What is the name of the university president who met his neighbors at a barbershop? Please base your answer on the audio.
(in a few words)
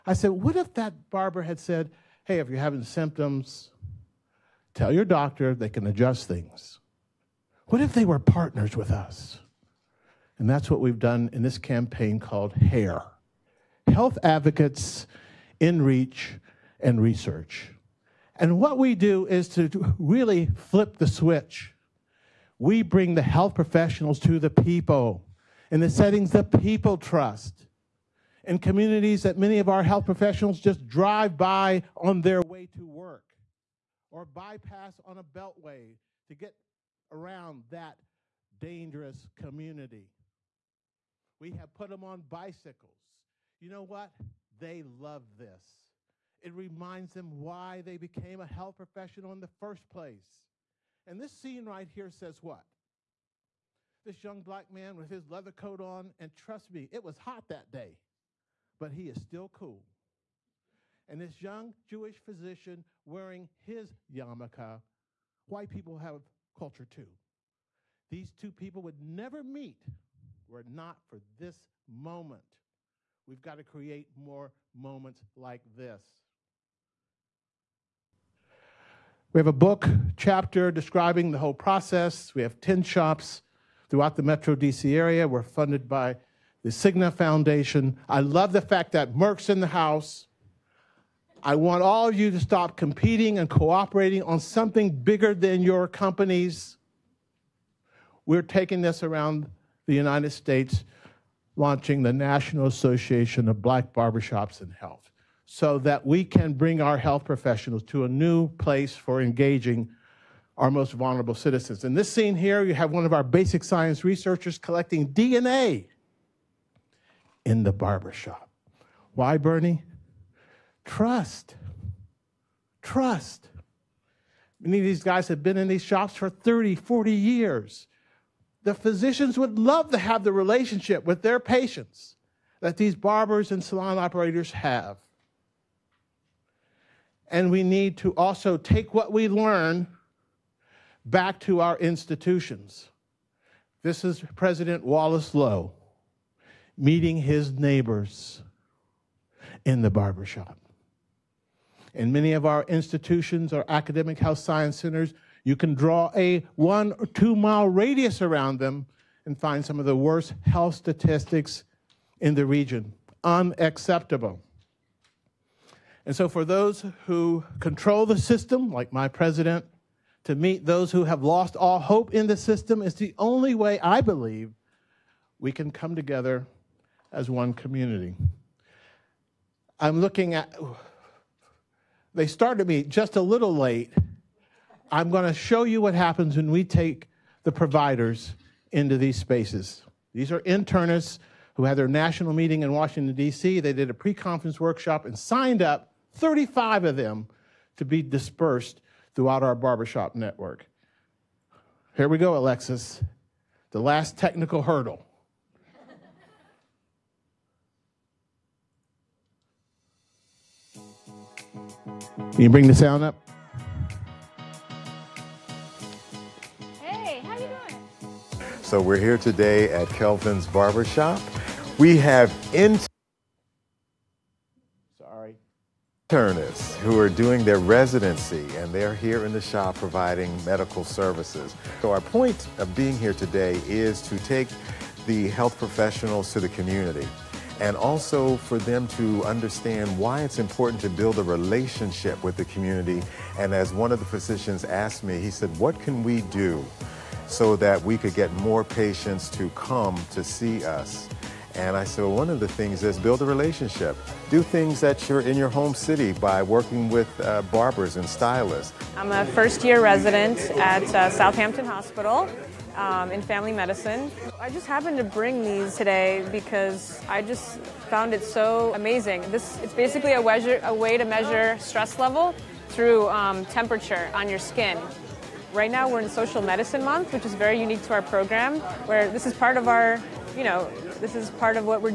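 Wallace Loh.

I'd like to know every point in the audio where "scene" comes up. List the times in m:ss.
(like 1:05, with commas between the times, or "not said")
0:51, 1:52.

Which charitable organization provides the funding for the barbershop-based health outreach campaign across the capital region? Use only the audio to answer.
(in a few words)
Cigna Foundation.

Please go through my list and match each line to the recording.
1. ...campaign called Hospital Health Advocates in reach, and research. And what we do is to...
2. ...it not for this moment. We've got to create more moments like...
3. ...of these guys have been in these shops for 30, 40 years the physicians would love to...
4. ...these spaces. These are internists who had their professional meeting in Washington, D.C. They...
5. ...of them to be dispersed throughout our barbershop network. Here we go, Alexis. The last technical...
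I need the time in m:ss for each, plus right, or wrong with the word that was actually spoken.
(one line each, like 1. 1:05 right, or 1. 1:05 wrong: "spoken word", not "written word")
1. 0:11 wrong: "HAIR", not "Hospital"
2. 1:10 right
3. 2:04 right
4. 3:08 wrong: "national", not "professional"
5. 3:16 right.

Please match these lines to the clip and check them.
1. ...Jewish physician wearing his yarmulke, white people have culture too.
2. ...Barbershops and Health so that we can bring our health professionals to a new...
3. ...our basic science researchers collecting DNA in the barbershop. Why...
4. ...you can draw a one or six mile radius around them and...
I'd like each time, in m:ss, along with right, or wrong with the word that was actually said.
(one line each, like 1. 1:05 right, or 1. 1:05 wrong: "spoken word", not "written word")
1. 1:01 right
2. 1:43 right
3. 1:53 right
4. 2:35 wrong: "two", not "six".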